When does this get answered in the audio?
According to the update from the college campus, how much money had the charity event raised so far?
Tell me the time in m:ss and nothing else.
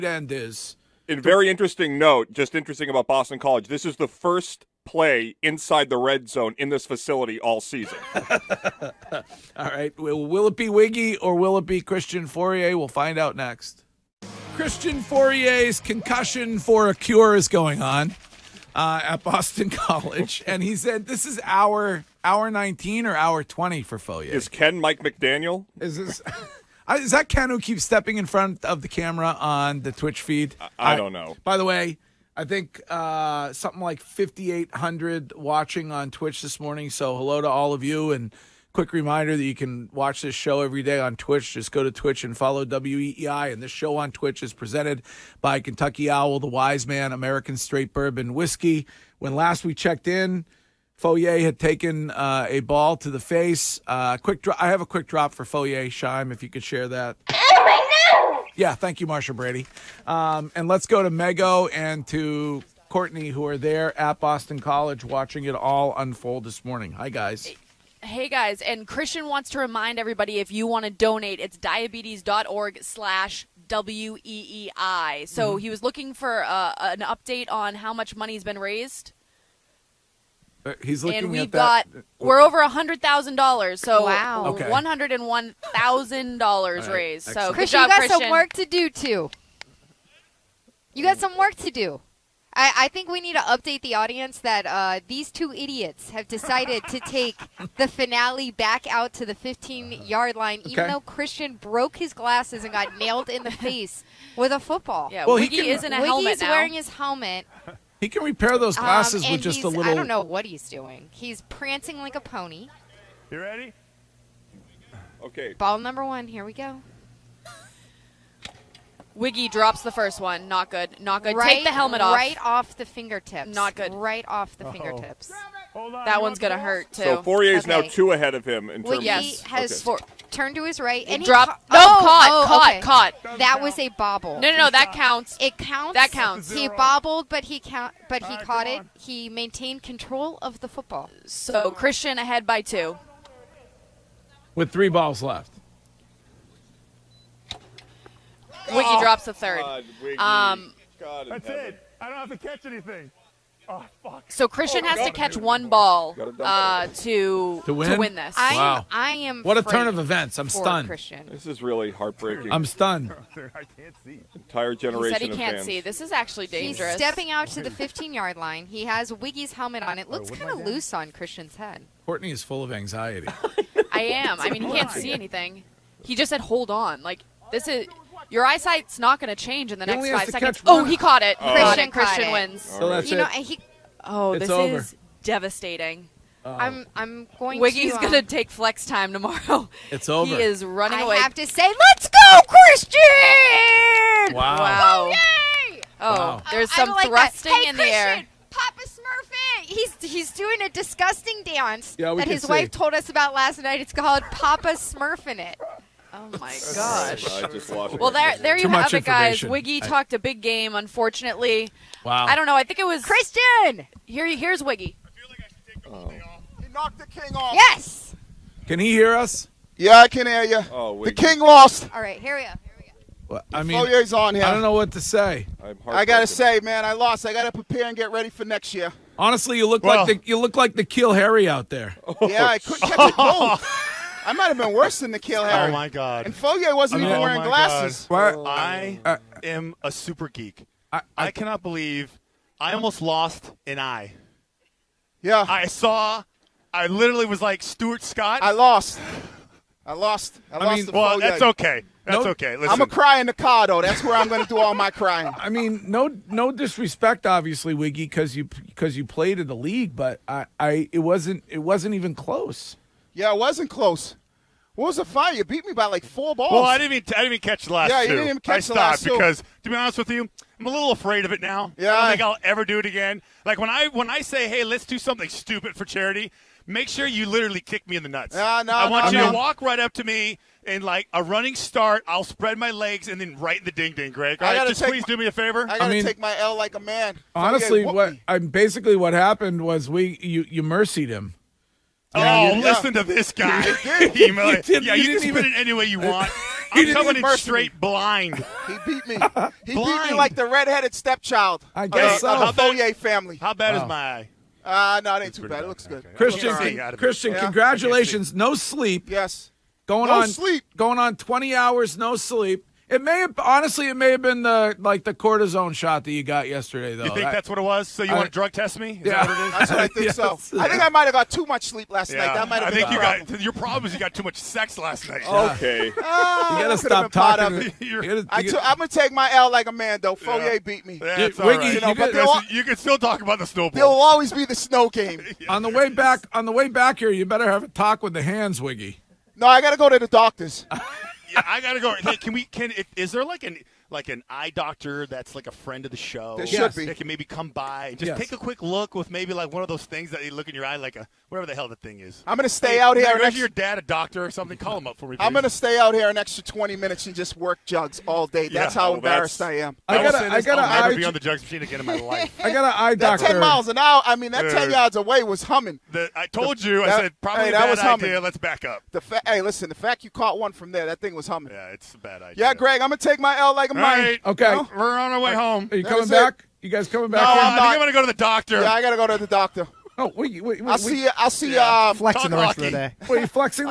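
1:24.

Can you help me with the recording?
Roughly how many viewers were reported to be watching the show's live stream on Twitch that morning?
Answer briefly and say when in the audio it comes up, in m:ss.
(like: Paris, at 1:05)
5,800, at 0:34.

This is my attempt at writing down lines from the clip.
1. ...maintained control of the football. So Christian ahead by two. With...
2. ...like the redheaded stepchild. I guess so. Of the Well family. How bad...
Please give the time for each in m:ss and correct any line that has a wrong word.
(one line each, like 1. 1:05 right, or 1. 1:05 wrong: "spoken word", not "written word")
1. 2:19 right
2. 5:00 wrong: "Foyer", not "Well".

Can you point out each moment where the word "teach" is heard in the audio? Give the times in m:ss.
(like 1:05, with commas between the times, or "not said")
not said.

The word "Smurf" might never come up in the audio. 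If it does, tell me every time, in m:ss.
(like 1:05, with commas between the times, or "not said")
3:18, 3:24.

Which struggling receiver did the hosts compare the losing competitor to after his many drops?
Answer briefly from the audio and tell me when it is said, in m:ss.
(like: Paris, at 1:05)
N'Keal Harry, at 3:50.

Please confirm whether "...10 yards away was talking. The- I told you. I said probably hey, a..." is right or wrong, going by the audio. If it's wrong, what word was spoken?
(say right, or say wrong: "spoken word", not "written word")
wrong: "humming", not "talking".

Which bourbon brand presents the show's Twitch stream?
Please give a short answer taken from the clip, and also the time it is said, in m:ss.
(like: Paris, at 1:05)
Kentucky Owl, at 0:45.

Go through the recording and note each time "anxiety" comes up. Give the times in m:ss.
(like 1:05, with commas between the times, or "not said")
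2:52.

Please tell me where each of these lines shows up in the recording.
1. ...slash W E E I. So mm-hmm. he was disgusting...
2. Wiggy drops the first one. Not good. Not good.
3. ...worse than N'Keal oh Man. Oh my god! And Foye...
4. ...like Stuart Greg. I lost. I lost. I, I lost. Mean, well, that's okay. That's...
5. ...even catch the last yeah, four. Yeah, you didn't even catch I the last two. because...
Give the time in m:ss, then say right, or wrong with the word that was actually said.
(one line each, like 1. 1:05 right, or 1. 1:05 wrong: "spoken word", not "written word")
1. 1:12 wrong: "looking", not "disgusting"
2. 1:59 right
3. 3:54 wrong: "Harry", not "Man"
4. 4:07 wrong: "Scott", not "Greg"
5. 4:27 wrong: "two", not "four".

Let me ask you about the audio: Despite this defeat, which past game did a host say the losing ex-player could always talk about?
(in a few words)
the snow game.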